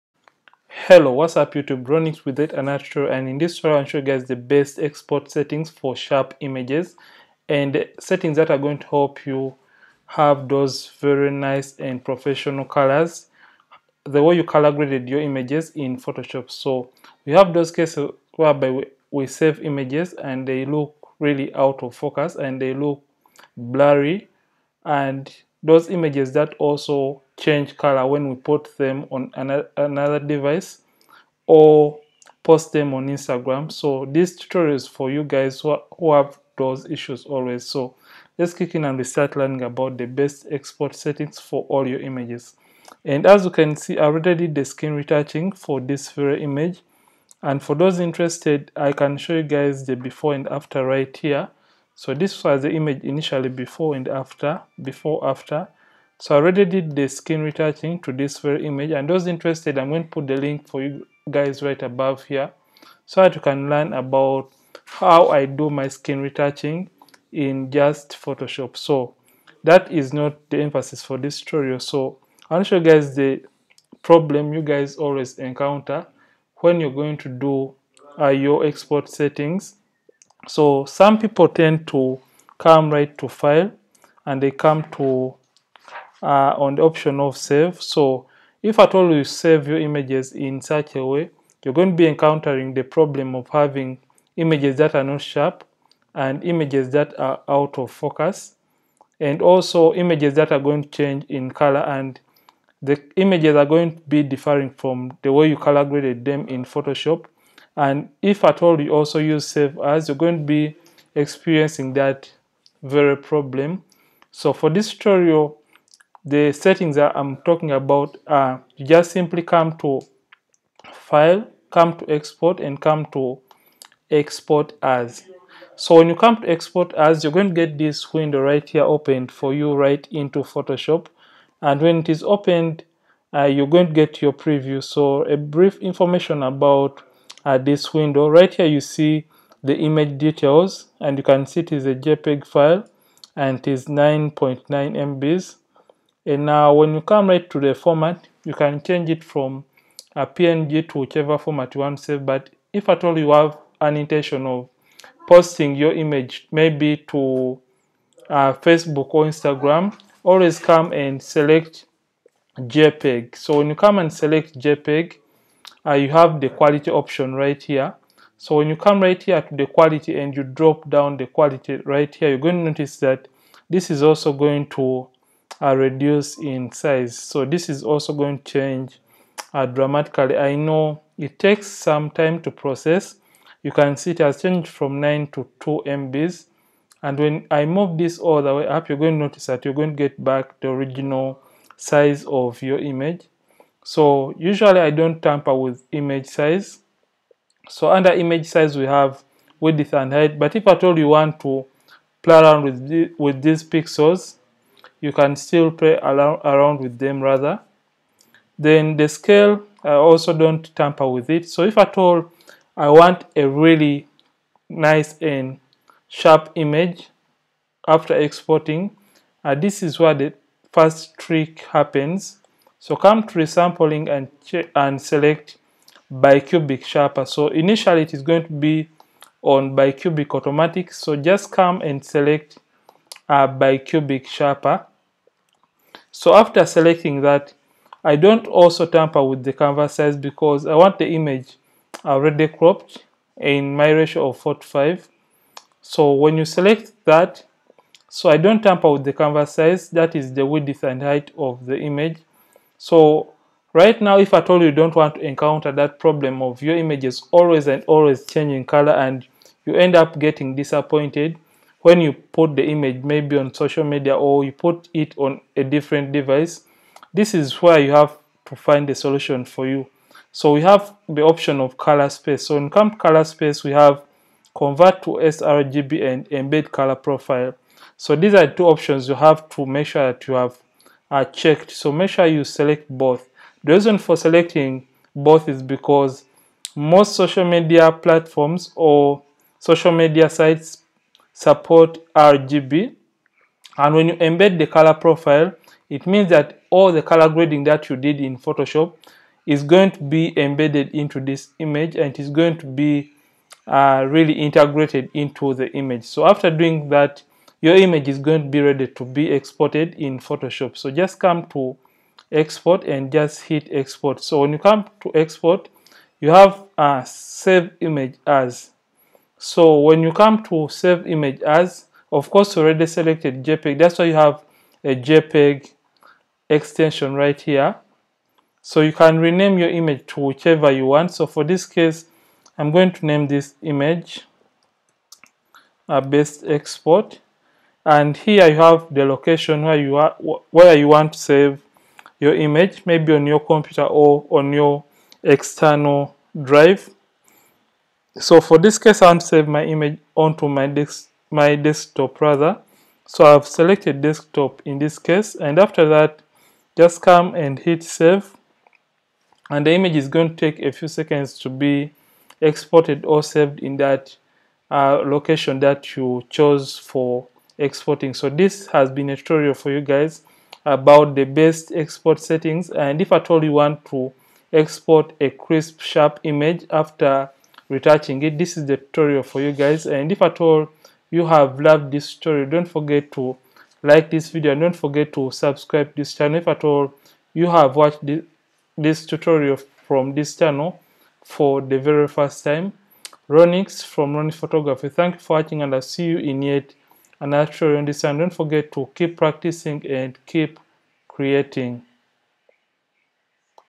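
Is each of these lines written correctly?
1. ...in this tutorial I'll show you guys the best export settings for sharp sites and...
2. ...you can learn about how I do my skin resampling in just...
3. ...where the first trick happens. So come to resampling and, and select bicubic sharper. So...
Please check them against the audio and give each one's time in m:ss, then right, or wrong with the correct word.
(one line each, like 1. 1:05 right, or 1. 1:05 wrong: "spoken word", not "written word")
1. 0:03 wrong: "images", not "sites"
2. 1:03 wrong: "retouching", not "resampling"
3. 3:39 right.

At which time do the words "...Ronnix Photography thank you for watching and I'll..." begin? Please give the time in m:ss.
6:34.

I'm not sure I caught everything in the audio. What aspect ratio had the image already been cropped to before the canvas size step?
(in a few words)
4:5.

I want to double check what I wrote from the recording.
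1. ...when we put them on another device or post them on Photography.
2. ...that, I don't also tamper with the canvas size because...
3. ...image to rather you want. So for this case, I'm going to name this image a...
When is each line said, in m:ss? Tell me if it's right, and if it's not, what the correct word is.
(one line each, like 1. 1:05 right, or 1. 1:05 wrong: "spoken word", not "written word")
1. 0:28 wrong: "Instagram", not "Photography"
2. 3:57 right
3. 5:29 wrong: "whichever", not "rather".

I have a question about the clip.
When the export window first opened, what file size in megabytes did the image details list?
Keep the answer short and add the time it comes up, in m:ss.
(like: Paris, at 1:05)
9.9 MB, at 2:23.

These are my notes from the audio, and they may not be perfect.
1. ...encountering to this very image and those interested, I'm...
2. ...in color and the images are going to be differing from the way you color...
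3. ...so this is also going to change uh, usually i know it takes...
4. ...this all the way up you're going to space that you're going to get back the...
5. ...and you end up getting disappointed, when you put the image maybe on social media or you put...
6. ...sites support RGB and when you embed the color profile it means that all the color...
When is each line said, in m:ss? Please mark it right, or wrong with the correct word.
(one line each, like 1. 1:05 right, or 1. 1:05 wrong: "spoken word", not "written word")
1. 0:57 wrong: "retouching", not "encountering"
2. 1:41 right
3. 2:57 wrong: "dramatically", not "usually"
4. 3:07 wrong: "notice", not "space"
5. 4:18 right
6. 4:50 right.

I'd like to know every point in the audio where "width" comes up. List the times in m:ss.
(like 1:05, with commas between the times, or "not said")
3:19, 4:10.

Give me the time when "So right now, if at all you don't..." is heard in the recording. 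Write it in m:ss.
4:12.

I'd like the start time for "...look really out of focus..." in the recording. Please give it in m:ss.
0:20.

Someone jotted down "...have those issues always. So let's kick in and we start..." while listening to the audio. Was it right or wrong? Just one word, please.
right.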